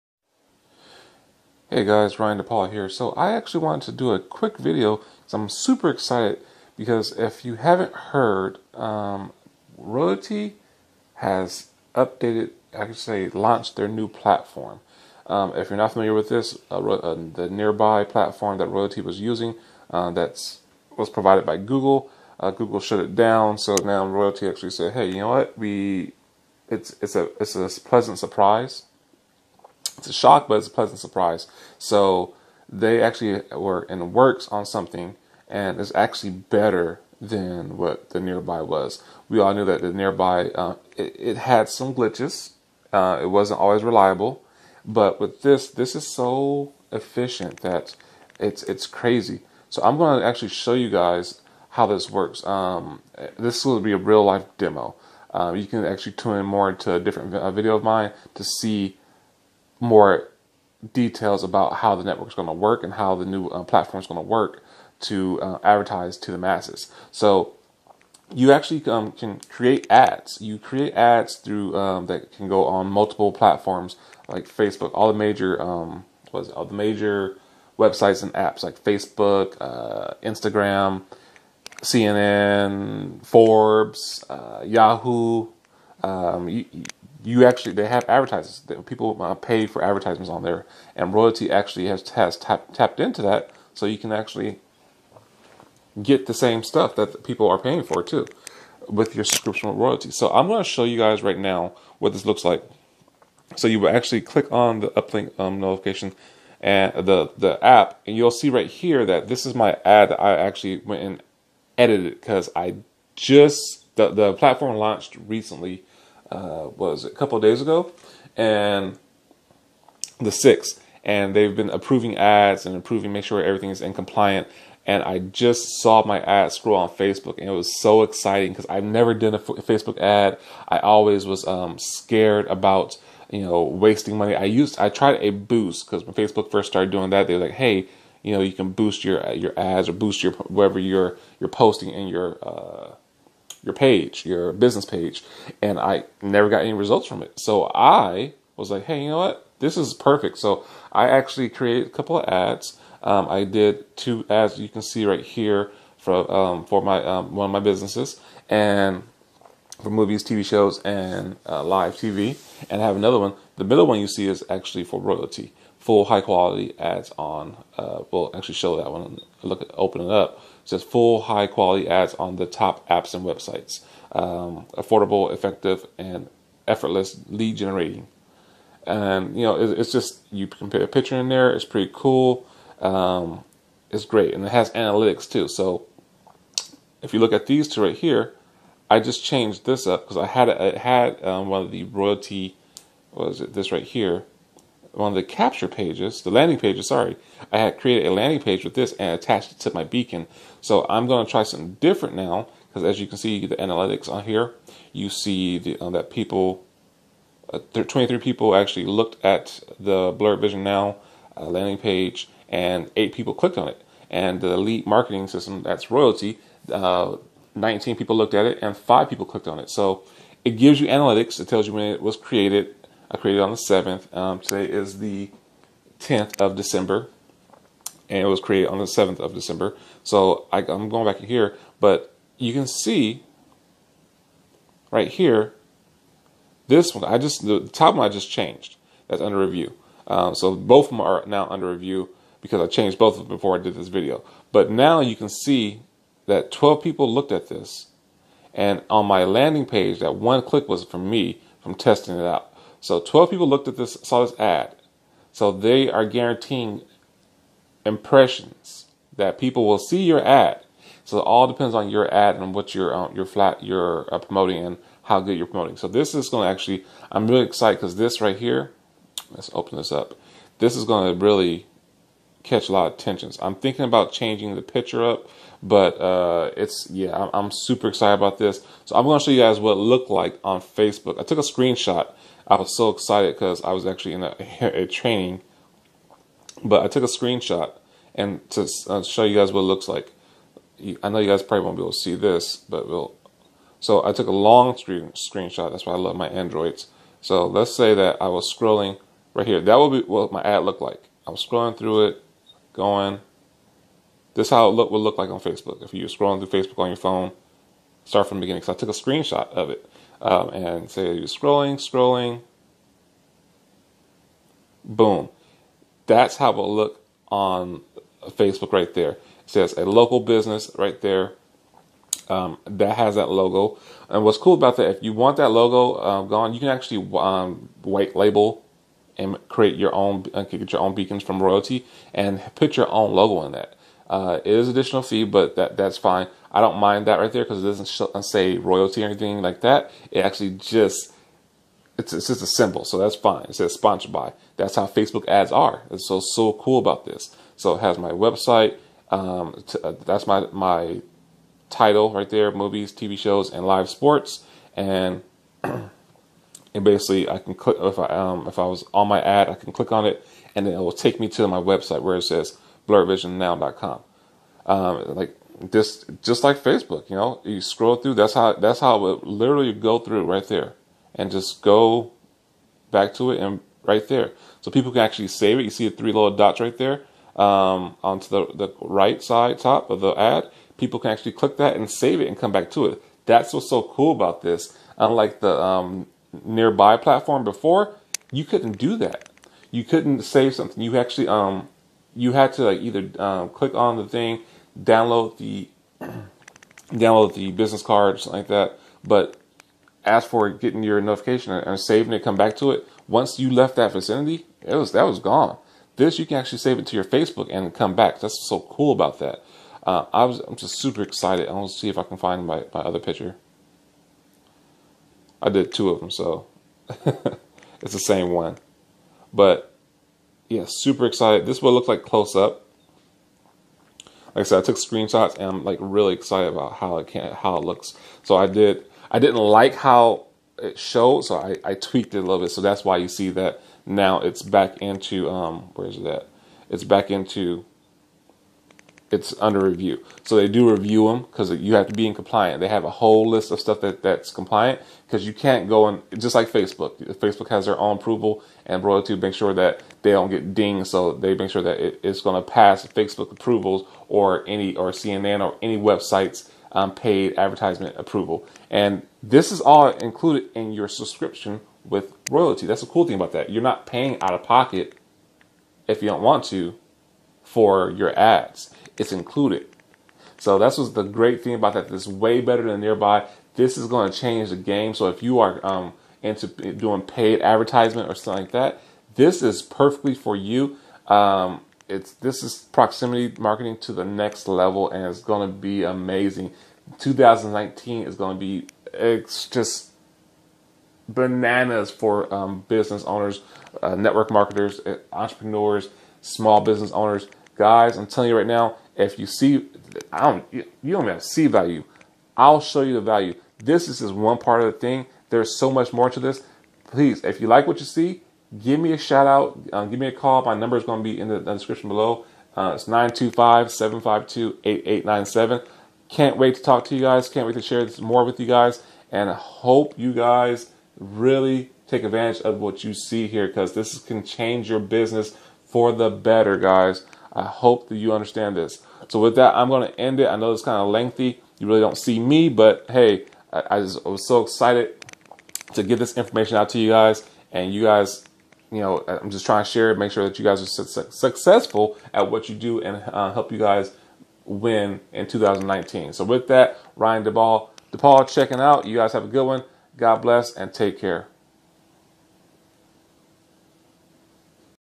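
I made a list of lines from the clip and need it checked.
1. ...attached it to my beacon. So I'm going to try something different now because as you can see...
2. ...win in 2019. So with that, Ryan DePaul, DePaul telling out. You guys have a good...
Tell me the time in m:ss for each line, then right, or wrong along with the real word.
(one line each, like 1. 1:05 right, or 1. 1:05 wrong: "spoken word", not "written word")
1. 3:19 right
2. 9:04 wrong: "checking", not "telling".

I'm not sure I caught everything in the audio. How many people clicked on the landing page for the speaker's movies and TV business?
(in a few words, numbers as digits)
8.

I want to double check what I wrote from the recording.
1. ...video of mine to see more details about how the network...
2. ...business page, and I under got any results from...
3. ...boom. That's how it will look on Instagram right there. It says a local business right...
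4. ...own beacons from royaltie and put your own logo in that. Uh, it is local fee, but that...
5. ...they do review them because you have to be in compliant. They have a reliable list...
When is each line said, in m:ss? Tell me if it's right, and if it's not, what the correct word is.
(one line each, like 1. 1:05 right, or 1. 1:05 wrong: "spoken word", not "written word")
1. 0:57 right
2. 2:24 wrong: "never", not "under"
3. 5:14 wrong: "Facebook", not "Instagram"
4. 5:30 wrong: "additional", not "local"
5. 7:20 wrong: "whole", not "reliable".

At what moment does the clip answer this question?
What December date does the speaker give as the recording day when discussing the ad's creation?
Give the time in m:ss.
3:44.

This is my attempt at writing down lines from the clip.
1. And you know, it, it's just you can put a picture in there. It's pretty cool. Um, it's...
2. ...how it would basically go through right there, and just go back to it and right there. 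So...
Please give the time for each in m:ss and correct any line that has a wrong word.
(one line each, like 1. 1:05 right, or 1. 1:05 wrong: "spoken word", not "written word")
1. 2:58 right
2. 6:08 wrong: "literally", not "basically".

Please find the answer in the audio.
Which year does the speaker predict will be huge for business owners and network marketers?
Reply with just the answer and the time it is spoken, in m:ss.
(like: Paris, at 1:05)
2019, at 8:06.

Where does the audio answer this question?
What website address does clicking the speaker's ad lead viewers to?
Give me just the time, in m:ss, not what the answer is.
6:02.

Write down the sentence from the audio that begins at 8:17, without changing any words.
Guys, I'm telling you right now, if you see, I don't, you don't have to see value.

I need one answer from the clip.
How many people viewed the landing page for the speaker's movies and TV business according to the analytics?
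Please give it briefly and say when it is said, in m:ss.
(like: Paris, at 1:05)
23, at 3:27.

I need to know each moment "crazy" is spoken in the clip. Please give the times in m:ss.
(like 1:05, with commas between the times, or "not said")
0:48.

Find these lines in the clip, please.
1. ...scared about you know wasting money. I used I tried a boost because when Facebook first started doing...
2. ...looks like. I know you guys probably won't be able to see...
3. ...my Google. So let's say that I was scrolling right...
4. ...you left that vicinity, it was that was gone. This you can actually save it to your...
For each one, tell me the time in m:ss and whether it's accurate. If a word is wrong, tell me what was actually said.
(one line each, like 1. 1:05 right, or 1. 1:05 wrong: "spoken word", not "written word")
1. 2:11 right
2. 4:49 right
3. 4:56 wrong: "Androids", not "Google"
4. 6:43 right.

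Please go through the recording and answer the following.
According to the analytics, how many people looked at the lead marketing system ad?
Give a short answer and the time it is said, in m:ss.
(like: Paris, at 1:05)
19, at 3:37.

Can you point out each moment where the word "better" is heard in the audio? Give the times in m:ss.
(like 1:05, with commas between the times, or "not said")
0:36, 7:52, 8:46.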